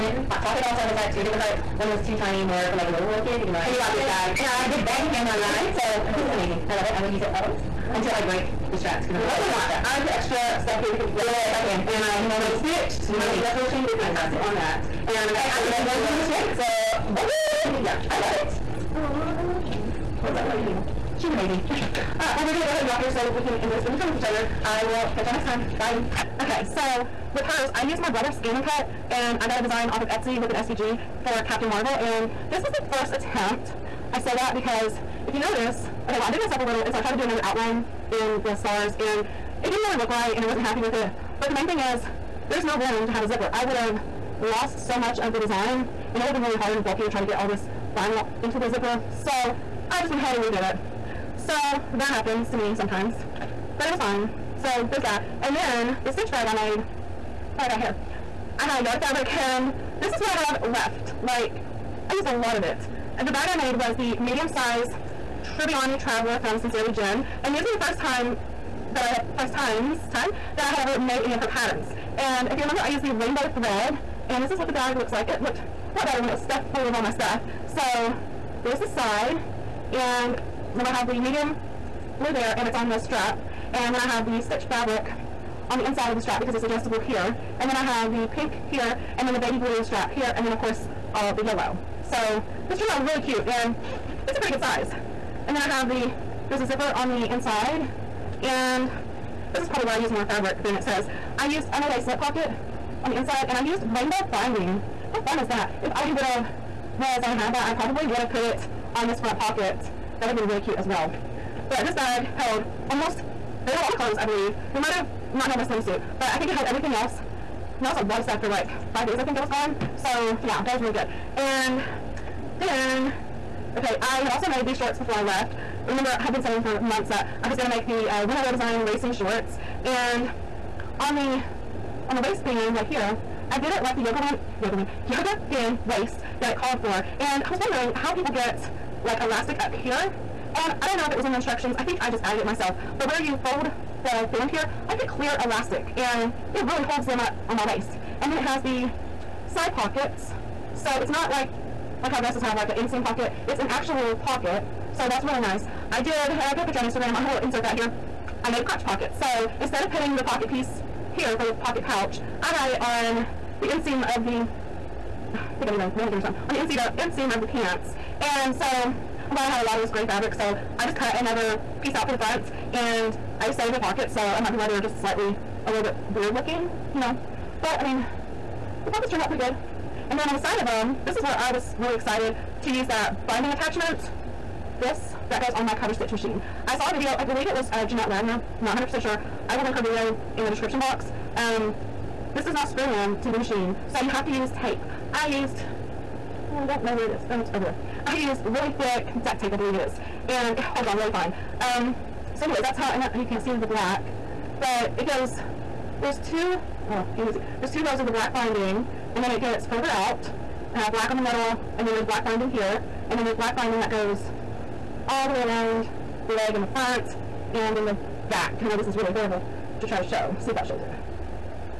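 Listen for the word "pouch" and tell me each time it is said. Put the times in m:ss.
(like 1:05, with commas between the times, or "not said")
2:41.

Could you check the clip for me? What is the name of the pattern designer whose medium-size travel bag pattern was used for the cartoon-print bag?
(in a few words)
Sincerely Jen.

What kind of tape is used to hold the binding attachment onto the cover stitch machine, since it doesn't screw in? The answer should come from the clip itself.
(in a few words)
duct tape.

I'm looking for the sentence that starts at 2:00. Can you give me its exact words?
So, yeah, that was really good.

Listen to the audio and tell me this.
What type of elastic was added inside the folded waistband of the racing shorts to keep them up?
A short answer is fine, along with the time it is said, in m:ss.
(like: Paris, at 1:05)
clear elastic, at 2:25.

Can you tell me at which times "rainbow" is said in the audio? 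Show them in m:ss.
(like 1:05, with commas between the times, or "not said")
1:13, 1:43.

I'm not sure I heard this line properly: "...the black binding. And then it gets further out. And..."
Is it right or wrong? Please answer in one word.
right.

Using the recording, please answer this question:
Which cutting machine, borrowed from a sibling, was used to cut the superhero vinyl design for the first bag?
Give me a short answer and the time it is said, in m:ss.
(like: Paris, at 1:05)
ScanNCut, at 0:28.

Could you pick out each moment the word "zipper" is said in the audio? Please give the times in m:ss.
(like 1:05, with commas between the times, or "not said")
0:43, 0:48, 1:36.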